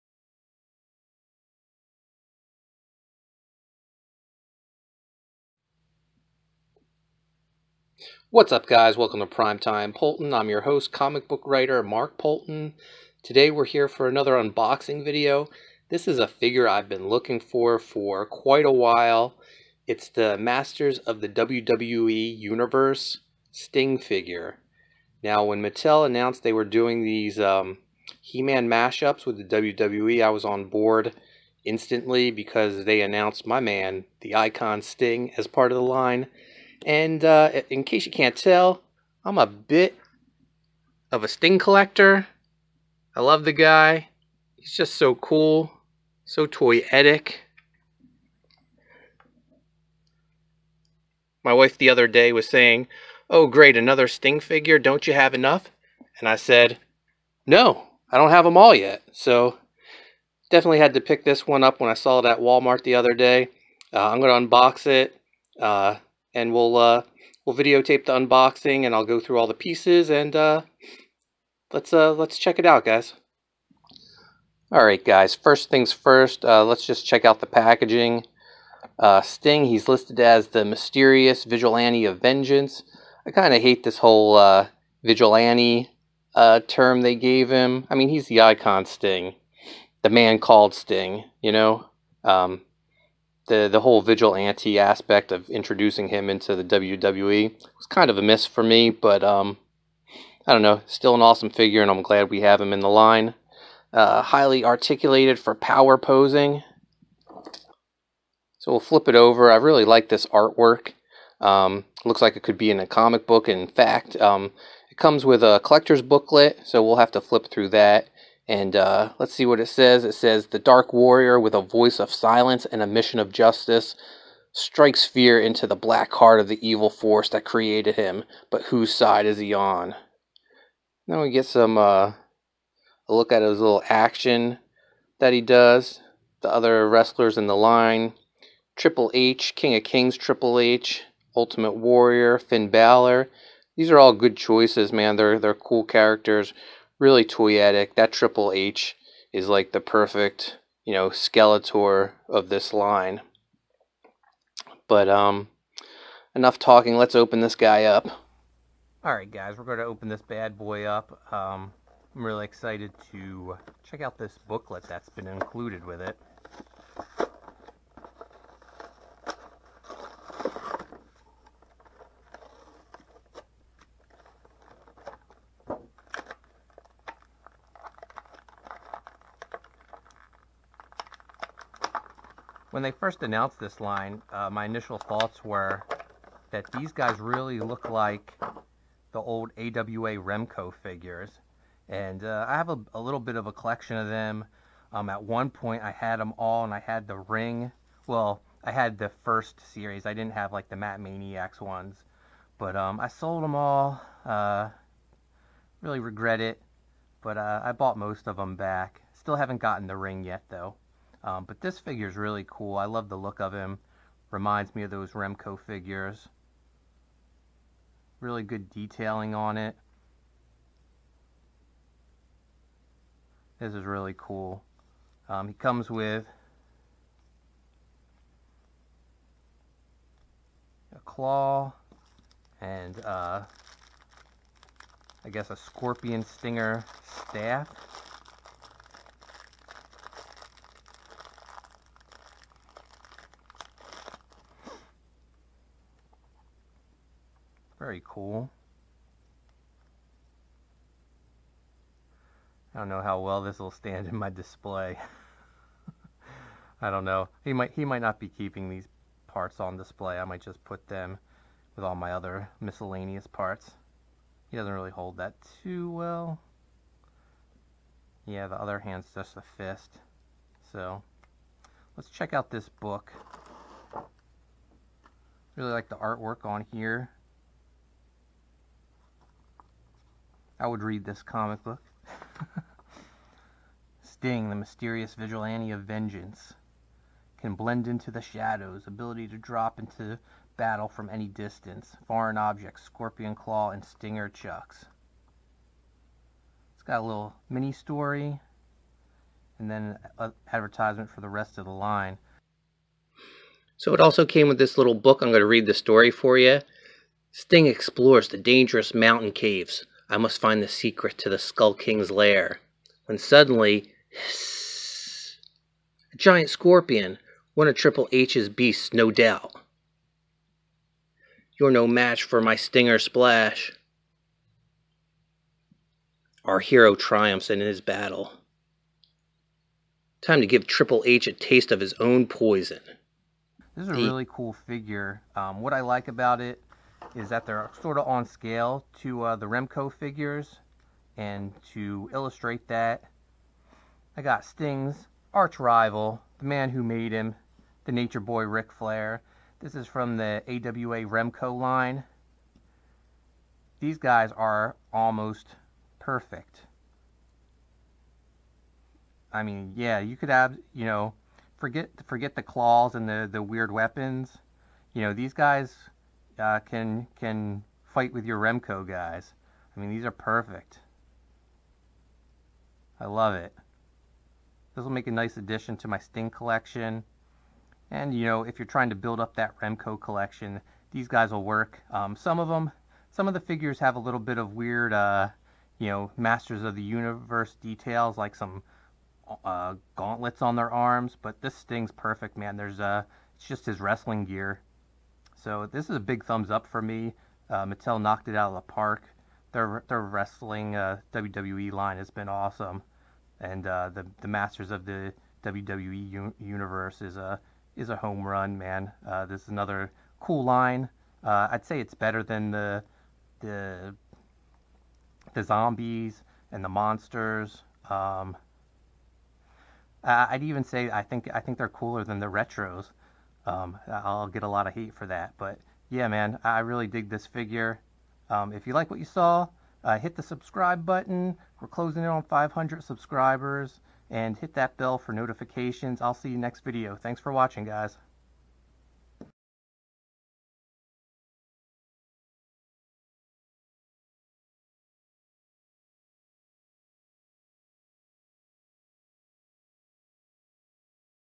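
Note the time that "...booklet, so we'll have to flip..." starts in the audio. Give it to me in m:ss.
1:56.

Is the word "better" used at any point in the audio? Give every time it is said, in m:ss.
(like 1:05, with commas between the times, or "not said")
6:51.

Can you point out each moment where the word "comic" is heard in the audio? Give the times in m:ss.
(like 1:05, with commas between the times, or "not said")
0:10, 1:52, 4:41.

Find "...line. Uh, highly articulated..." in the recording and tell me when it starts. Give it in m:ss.
1:42.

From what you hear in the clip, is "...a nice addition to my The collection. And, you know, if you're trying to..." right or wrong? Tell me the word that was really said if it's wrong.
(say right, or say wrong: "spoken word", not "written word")
wrong: "Sting", not "The".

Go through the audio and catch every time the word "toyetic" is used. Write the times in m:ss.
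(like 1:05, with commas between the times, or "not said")
0:46, 2:27.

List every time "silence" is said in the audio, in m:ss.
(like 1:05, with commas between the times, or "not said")
2:02.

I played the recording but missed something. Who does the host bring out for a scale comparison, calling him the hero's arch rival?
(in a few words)
Ric Flair.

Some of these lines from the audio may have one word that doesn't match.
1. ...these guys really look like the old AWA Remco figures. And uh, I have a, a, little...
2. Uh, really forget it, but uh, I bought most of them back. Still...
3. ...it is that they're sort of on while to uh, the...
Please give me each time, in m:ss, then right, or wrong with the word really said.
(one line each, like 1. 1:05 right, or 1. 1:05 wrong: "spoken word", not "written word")
1. 3:06 right
2. 3:24 wrong: "regret", not "forget"
3. 5:36 wrong: "scale", not "while".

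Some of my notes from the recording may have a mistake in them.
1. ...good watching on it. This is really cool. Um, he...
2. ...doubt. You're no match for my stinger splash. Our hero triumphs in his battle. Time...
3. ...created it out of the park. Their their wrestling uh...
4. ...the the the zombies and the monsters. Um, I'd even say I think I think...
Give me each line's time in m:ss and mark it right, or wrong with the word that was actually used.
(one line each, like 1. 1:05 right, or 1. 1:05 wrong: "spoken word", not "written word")
1. 3:38 wrong: "detailing", not "watching"
2. 5:19 right
3. 6:37 wrong: "knocked", not "created"
4. 6:52 right.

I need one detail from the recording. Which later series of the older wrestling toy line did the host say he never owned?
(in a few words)
Mat Maniacs.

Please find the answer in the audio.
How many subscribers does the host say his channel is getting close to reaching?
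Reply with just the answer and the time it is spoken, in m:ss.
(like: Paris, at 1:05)
500, at 7:12.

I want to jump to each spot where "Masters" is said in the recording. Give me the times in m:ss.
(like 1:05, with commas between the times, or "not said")
0:20, 6:26, 6:44.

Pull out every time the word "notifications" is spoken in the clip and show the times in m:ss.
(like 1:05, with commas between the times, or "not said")
7:15.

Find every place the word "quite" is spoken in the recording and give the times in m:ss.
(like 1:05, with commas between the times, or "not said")
0:18.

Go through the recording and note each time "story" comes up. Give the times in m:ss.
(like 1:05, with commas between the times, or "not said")
4:57, 5:05.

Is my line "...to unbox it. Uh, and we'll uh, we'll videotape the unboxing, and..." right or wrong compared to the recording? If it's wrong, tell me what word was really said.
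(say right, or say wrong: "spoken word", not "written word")
right.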